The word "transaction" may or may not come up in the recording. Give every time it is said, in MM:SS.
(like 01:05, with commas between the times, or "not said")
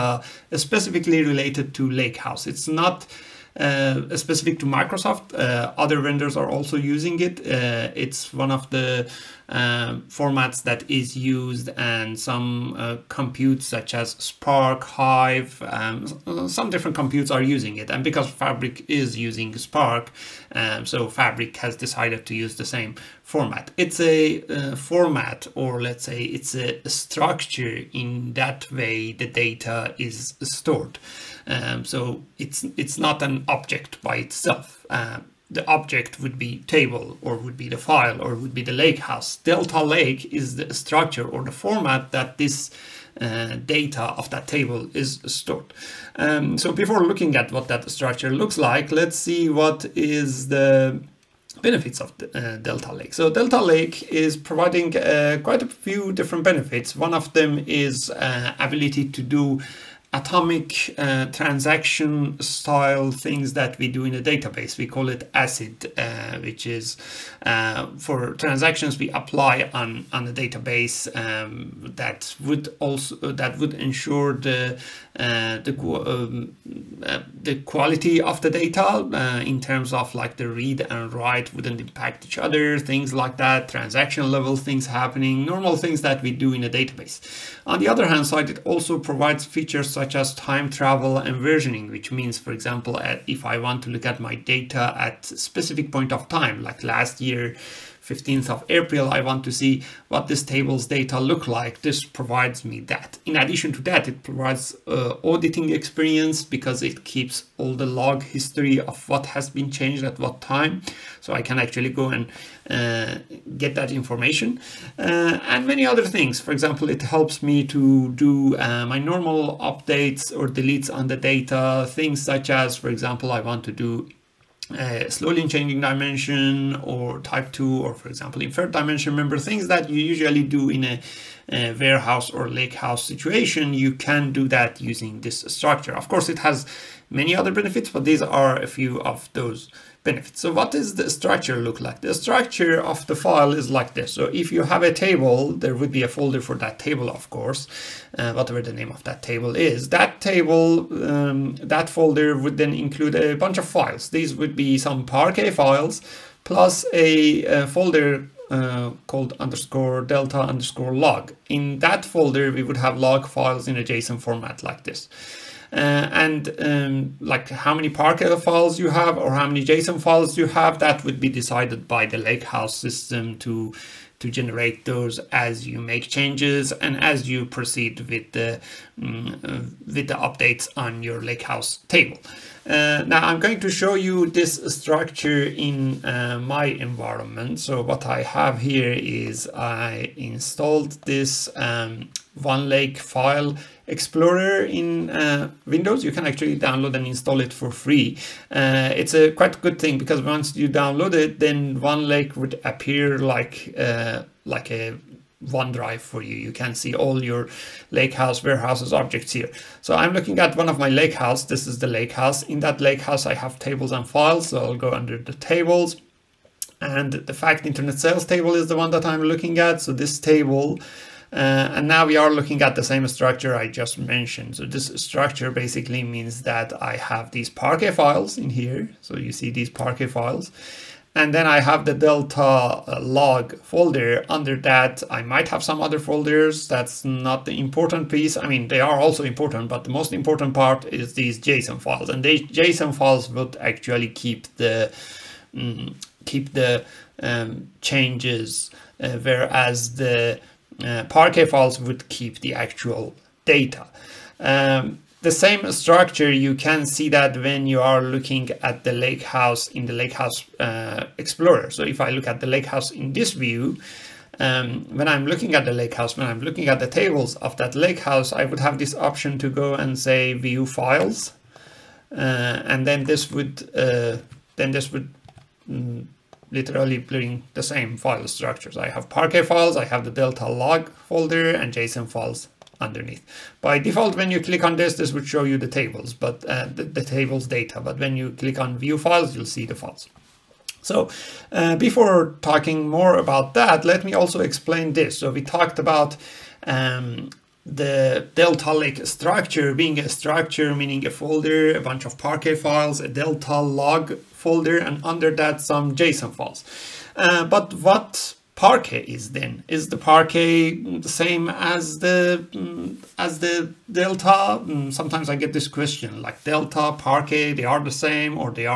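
01:01, 01:08, 01:23.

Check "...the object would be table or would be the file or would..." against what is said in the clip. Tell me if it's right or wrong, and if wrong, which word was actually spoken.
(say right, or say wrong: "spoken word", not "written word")
right.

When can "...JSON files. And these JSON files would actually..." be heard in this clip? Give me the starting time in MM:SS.
04:01.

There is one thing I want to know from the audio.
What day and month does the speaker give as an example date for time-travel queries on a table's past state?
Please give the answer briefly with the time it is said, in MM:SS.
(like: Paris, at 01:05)
15th of April, at 01:38.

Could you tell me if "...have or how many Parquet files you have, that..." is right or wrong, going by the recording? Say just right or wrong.
wrong.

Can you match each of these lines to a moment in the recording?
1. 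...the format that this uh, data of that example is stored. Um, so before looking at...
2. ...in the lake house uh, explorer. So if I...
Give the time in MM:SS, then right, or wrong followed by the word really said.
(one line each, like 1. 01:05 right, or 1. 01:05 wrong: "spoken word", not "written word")
1. 00:41 wrong: "table", not "example"
2. 04:19 right.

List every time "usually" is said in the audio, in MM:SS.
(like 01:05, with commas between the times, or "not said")
02:10.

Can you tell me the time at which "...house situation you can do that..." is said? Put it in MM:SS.
02:12.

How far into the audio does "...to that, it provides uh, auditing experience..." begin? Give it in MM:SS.
01:43.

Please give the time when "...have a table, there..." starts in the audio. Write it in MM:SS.
02:24.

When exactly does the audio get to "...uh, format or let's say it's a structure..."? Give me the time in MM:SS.
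00:24.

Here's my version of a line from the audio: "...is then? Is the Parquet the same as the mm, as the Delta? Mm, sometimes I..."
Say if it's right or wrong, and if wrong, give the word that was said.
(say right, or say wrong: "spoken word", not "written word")
right.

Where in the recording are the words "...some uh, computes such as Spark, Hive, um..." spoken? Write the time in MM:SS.
00:12.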